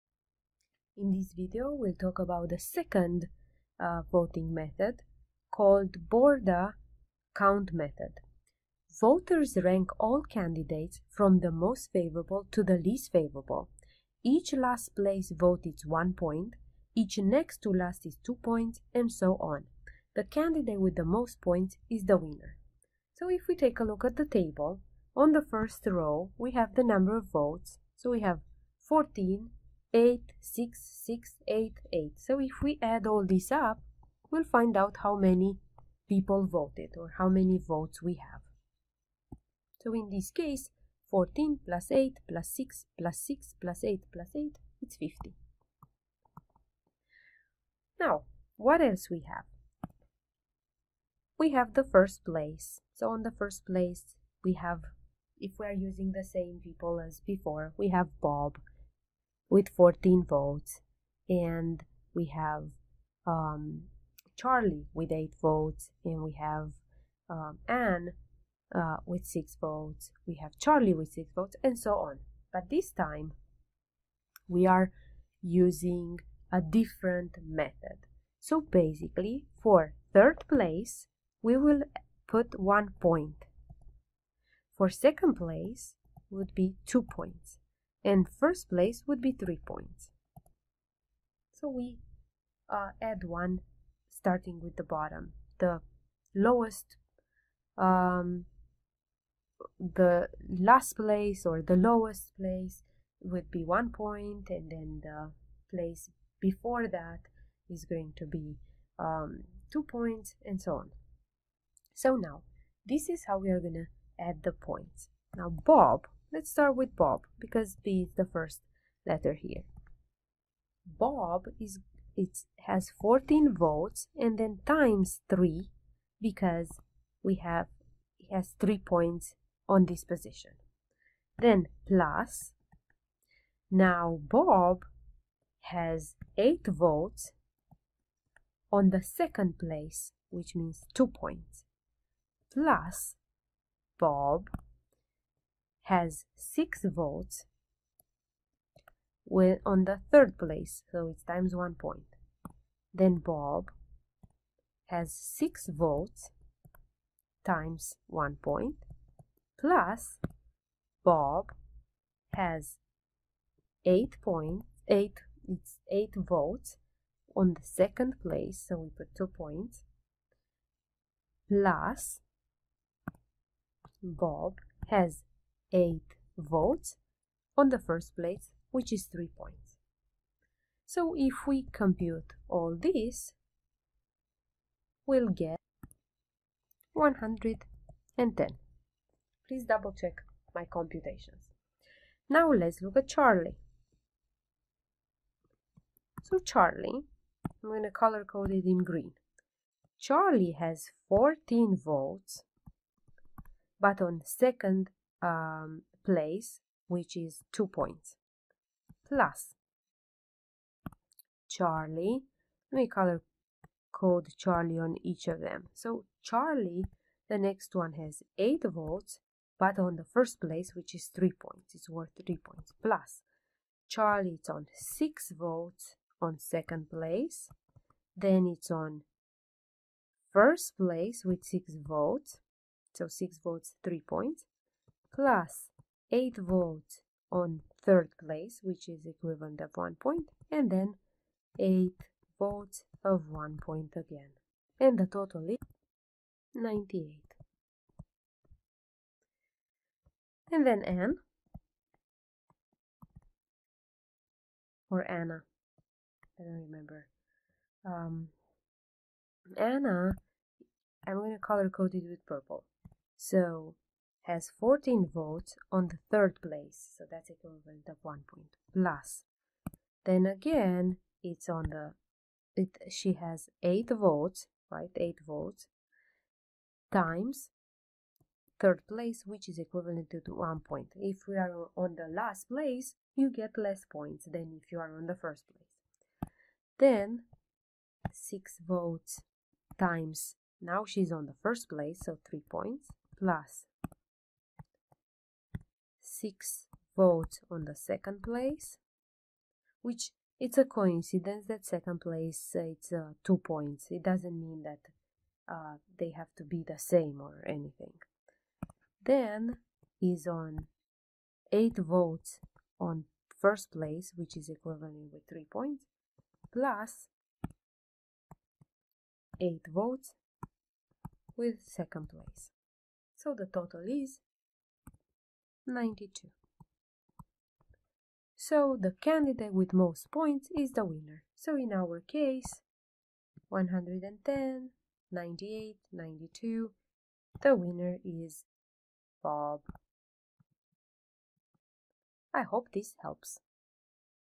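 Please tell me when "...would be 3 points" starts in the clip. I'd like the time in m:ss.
1:29.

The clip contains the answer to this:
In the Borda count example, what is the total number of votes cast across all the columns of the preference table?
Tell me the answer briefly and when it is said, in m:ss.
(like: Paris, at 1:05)
50, at 0:44.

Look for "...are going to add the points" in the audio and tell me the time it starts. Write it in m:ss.
1:53.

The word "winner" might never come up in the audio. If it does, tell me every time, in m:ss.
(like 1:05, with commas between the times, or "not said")
0:22, 5:30, 5:37.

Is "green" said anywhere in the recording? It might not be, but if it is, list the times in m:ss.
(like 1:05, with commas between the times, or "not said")
3:18.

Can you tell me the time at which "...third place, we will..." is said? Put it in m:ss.
1:20.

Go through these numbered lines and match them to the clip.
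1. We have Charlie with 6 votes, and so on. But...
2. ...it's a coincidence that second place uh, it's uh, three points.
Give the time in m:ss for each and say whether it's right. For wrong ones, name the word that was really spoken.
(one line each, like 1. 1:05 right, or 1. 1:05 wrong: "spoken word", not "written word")
1. 1:10 right
2. 5:00 wrong: "two", not "three".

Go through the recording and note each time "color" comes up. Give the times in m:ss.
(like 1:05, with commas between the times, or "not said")
3:17, 3:32, 4:21.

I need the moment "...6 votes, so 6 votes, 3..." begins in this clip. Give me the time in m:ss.
3:51.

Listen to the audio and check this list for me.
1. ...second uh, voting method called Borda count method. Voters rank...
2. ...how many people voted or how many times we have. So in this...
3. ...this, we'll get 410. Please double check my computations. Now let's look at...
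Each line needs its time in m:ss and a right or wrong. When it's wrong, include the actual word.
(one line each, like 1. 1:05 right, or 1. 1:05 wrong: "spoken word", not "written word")
1. 0:02 right
2. 0:35 wrong: "votes", not "times"
3. 3:02 wrong: "110", not "410".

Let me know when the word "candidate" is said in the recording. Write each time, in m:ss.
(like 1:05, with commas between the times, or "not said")
0:10, 0:20, 5:28.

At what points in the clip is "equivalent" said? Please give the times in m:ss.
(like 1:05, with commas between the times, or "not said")
3:59, 4:27, 4:39, 5:14.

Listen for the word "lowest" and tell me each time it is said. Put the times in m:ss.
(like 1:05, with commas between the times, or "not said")
1:36, 1:41.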